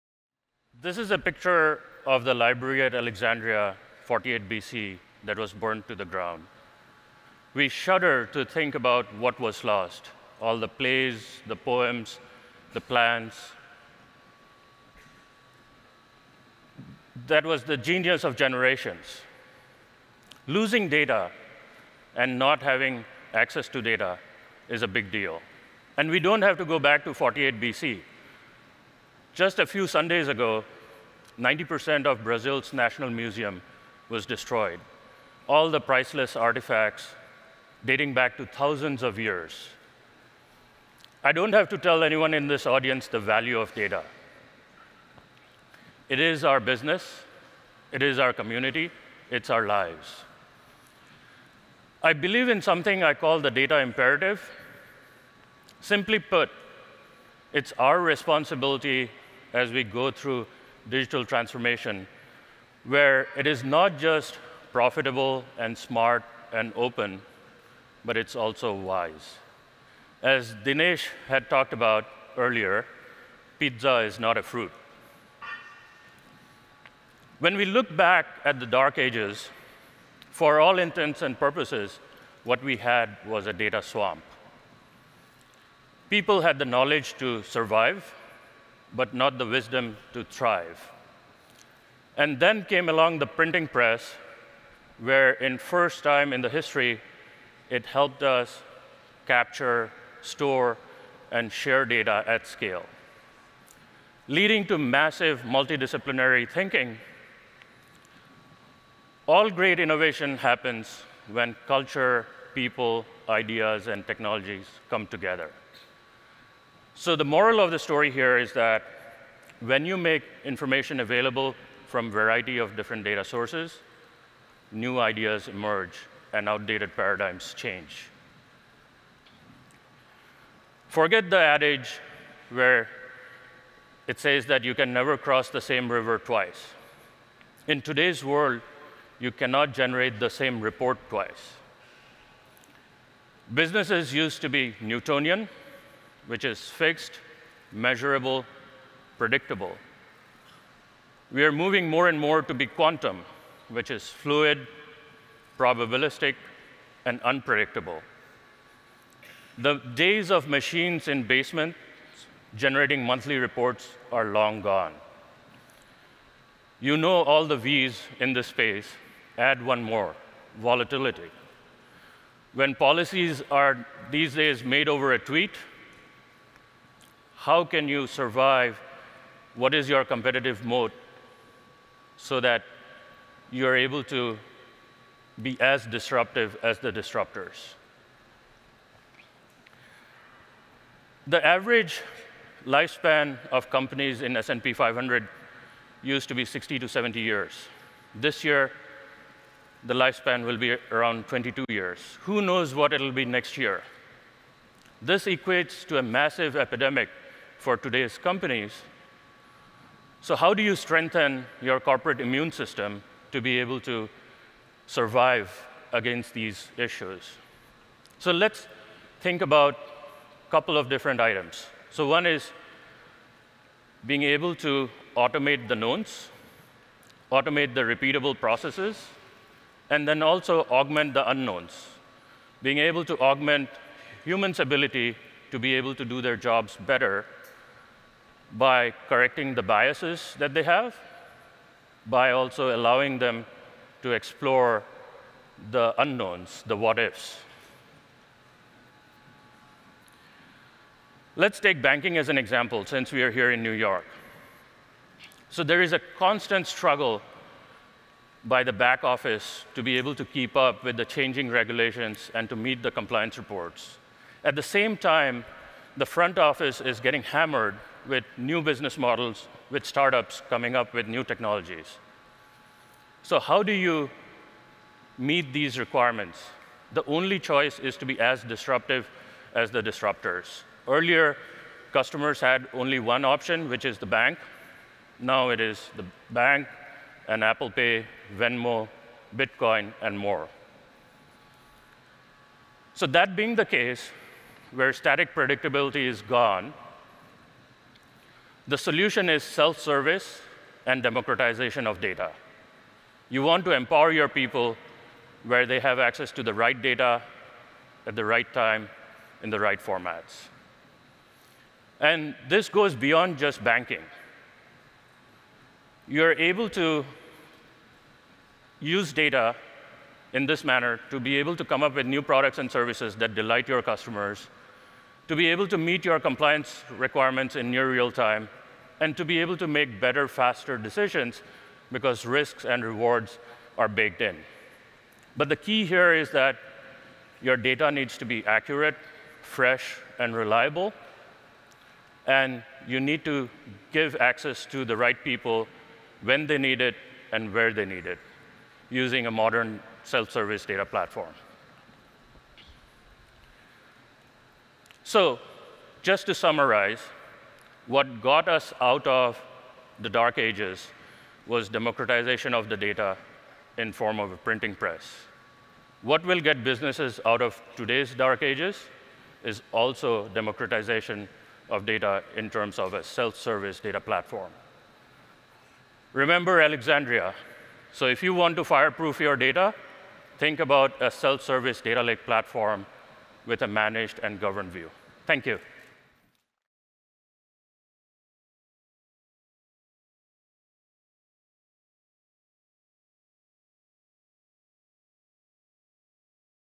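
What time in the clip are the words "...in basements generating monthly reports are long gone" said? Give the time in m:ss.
2:41.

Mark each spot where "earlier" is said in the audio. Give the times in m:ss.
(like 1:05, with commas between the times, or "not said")
1:12, 4:40.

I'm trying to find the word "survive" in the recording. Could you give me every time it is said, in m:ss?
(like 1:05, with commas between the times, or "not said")
1:27, 2:58, 3:34.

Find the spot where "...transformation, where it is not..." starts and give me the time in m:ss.
1:01.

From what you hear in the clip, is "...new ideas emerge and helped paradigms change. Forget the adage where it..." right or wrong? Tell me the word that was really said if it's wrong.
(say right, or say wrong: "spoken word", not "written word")
wrong: "outdated", not "helped".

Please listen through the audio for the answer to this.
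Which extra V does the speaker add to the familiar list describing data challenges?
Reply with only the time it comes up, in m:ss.
2:50.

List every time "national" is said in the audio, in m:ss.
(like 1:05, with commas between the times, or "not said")
0:32.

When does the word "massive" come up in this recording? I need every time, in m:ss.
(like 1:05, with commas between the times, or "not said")
1:44, 3:26.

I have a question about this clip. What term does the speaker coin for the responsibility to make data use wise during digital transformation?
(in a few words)
data imperative.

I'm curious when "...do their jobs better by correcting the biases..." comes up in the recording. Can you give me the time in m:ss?
3:56.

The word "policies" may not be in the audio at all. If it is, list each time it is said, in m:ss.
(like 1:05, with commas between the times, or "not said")
2:52.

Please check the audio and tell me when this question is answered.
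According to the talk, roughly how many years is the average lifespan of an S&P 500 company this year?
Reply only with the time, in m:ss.
3:21.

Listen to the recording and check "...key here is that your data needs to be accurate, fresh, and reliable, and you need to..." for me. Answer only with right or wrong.
right.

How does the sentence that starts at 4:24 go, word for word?
At the same time, the front office is getting hammered with new business models, with startups coming up with new technologies.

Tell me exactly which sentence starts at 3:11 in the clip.
The average lifespan of companies in S&P 500 used to be 60 to 70 years.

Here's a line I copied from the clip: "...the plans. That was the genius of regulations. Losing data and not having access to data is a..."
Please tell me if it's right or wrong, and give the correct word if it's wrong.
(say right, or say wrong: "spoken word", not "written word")
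wrong: "generations", not "regulations".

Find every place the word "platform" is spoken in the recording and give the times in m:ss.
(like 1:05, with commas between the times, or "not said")
5:50, 6:13, 6:22.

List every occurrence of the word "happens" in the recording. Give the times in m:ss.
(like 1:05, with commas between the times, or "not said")
1:50.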